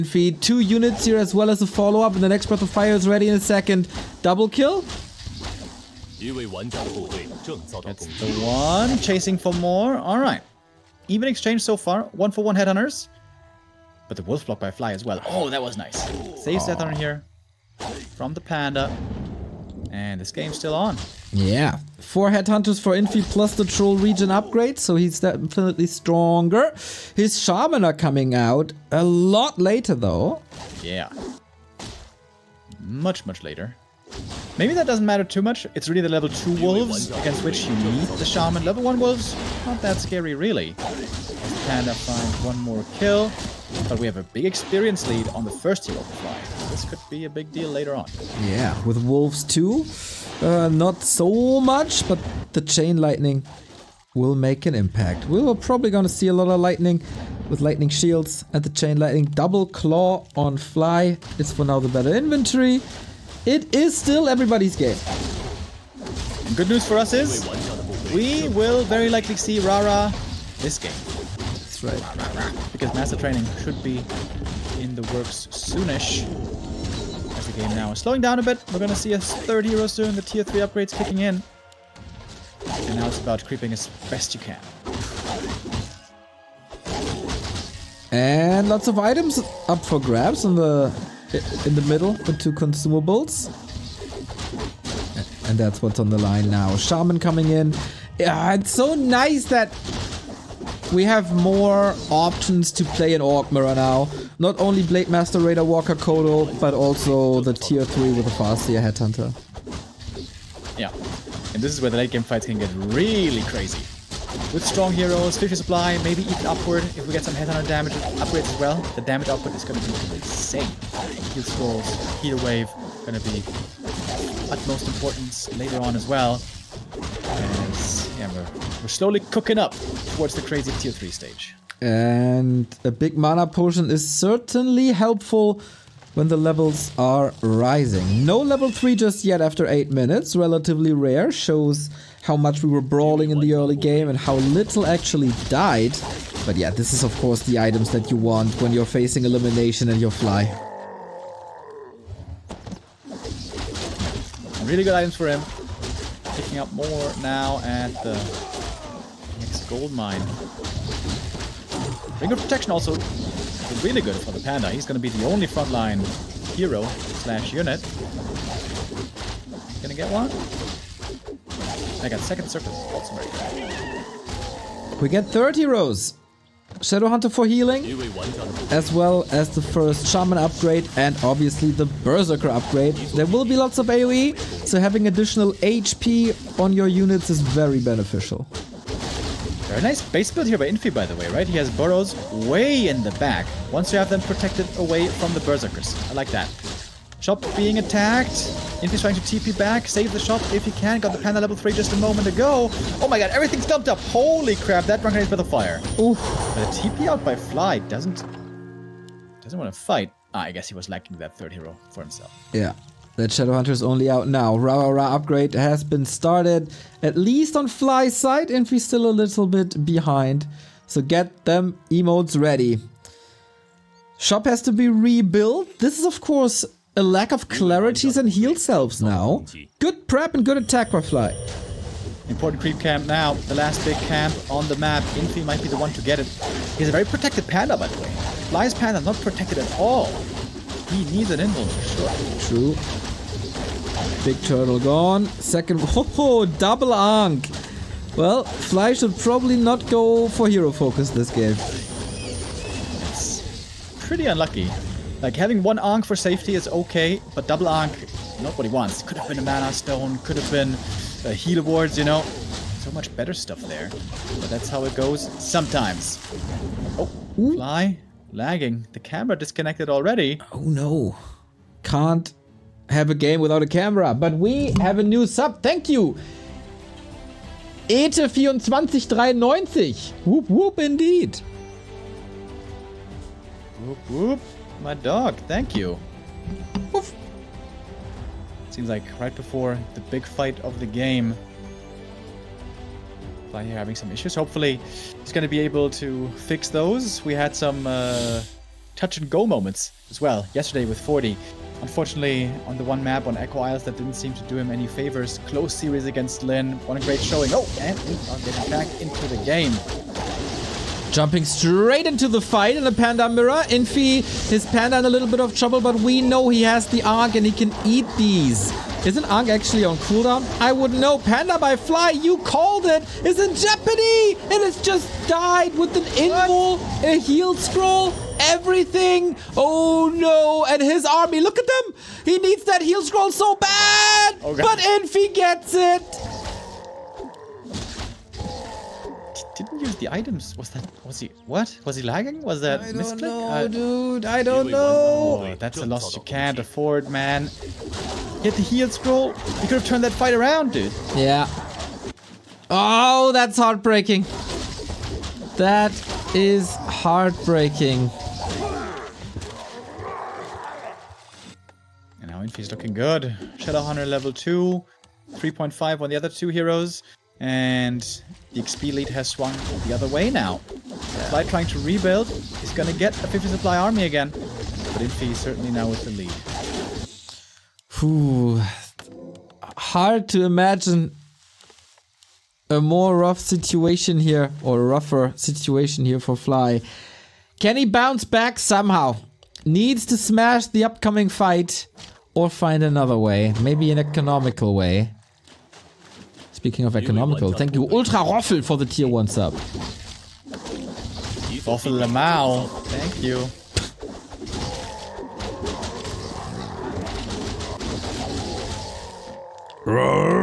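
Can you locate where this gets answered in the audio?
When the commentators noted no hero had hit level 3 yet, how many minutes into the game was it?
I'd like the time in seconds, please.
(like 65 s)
139 s.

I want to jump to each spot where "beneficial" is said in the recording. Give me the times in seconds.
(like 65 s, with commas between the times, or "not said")
187 s.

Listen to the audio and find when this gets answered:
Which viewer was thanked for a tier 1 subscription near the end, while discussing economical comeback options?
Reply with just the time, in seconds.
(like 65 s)
397 s.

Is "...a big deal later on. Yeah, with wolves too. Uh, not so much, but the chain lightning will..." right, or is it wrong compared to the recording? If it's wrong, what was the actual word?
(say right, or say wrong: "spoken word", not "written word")
right.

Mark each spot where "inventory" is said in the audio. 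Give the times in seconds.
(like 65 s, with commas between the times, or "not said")
62 s.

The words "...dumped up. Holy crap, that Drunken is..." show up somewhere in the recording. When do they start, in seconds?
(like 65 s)
203 s.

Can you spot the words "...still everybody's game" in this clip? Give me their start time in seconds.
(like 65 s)
63 s.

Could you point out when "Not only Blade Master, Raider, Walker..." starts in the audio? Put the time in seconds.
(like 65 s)
104 s.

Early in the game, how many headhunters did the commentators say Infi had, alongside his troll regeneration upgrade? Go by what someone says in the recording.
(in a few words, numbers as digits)
4.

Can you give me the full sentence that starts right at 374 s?
But Infi certainly now with the lead.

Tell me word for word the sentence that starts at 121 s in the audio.
Heal Scrolls, Heal Wave, going to be utmost importance later on as well.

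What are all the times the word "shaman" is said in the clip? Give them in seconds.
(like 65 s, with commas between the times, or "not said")
27 s, 38 s, 96 s, 180 s.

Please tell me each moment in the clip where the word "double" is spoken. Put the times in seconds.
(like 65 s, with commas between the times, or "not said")
4 s, 59 s, 246 s, 257 s.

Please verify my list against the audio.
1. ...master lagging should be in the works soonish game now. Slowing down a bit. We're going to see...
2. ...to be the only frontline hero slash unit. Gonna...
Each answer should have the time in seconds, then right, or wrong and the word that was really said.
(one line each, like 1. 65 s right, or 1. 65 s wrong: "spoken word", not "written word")
1. 72 s wrong: "training", not "lagging"
2. 165 s right.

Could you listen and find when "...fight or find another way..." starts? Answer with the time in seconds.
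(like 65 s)
391 s.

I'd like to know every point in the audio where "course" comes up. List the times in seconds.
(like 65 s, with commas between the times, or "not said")
147 s, 226 s.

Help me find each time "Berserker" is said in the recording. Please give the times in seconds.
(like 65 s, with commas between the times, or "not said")
181 s, 195 s.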